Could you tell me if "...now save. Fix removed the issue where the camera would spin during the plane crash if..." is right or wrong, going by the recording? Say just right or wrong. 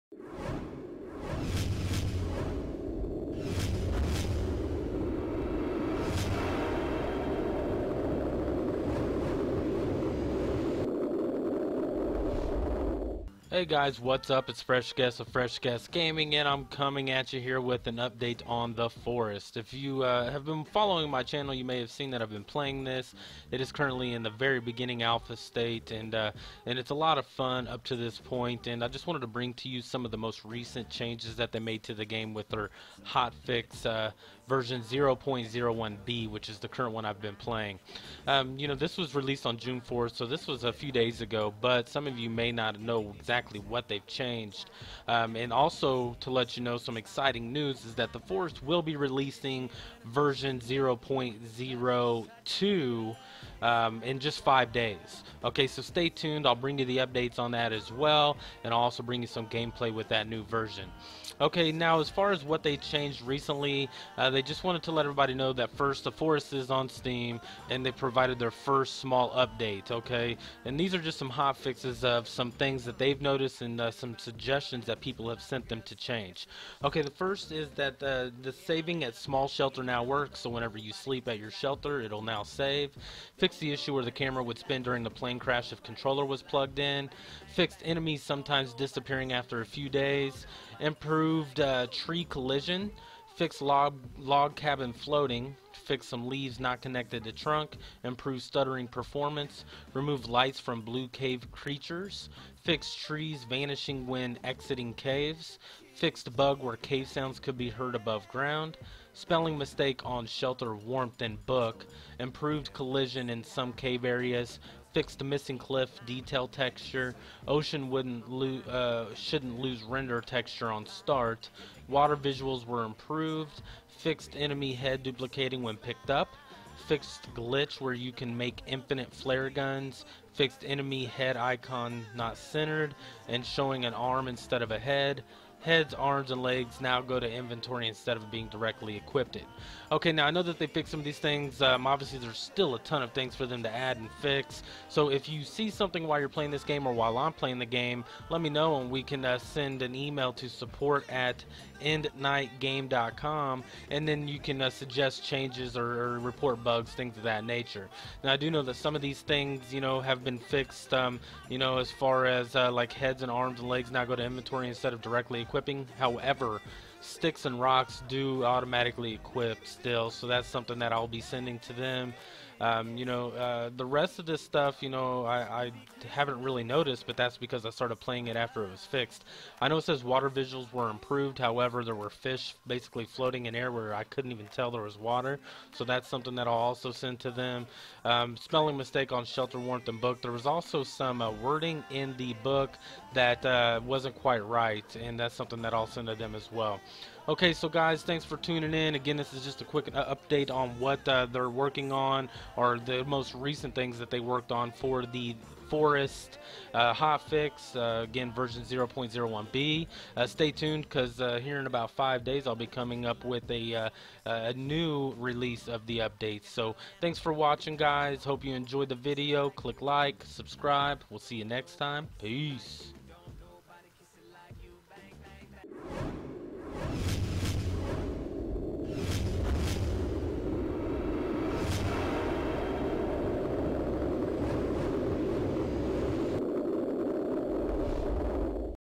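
wrong.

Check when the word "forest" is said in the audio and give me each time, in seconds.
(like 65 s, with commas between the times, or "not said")
18 s, 48 s, 66 s, 205 s.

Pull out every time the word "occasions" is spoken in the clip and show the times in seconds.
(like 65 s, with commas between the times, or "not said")
not said.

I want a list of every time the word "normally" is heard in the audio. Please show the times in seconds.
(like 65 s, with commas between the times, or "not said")
not said.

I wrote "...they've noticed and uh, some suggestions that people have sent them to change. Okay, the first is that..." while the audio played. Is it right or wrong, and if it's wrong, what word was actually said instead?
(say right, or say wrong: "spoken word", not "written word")
right.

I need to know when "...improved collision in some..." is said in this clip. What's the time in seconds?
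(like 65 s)
112 s.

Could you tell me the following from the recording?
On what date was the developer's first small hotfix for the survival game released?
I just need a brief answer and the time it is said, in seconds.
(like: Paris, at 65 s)
June 4th, at 39 s.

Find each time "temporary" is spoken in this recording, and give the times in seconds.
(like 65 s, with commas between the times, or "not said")
not said.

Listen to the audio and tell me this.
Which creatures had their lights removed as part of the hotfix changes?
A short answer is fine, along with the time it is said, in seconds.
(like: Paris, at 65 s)
blue cave creatures, at 100 s.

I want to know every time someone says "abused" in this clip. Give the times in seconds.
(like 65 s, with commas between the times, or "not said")
not said.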